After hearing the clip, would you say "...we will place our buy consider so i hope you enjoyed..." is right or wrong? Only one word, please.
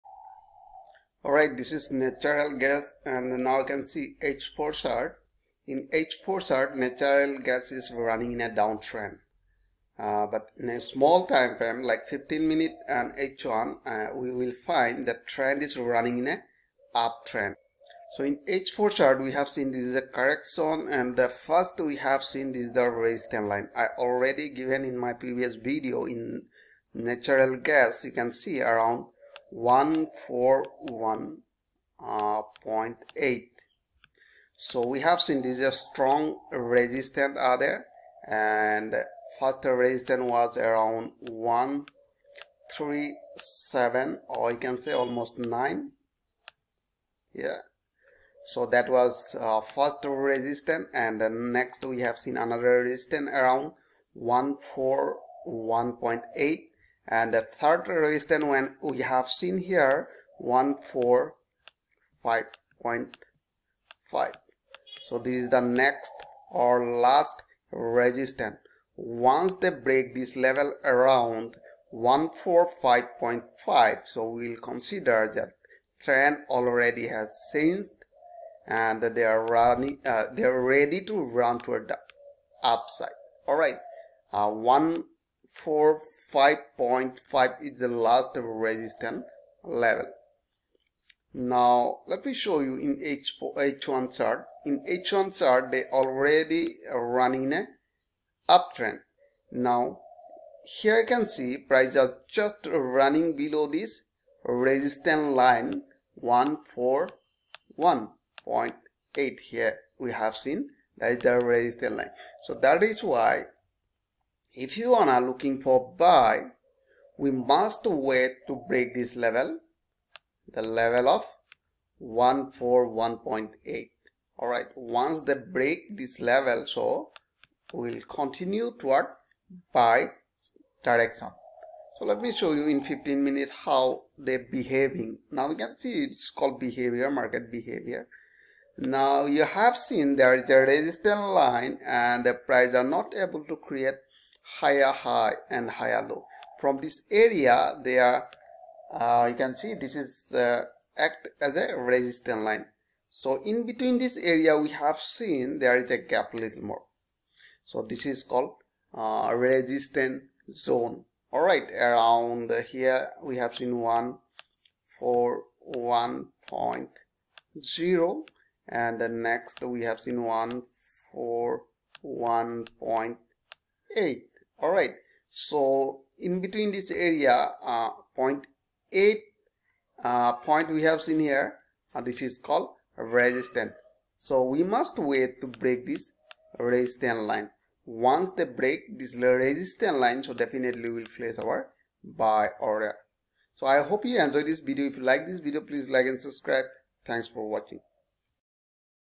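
wrong.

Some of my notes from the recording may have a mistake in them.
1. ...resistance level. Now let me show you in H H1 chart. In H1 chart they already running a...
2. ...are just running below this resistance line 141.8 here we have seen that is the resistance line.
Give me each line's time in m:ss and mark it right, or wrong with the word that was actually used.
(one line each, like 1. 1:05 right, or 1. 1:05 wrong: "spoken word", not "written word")
1. 1:28 right
2. 1:41 right.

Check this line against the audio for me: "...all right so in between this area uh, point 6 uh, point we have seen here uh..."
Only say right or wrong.
wrong.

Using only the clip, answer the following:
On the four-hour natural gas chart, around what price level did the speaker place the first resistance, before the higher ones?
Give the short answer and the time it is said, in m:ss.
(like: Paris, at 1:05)
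137, at 0:41.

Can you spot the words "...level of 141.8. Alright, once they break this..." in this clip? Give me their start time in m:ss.
2:00.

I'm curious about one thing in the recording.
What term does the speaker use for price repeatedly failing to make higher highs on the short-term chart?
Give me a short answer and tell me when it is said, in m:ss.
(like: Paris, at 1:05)
market behavior, at 2:17.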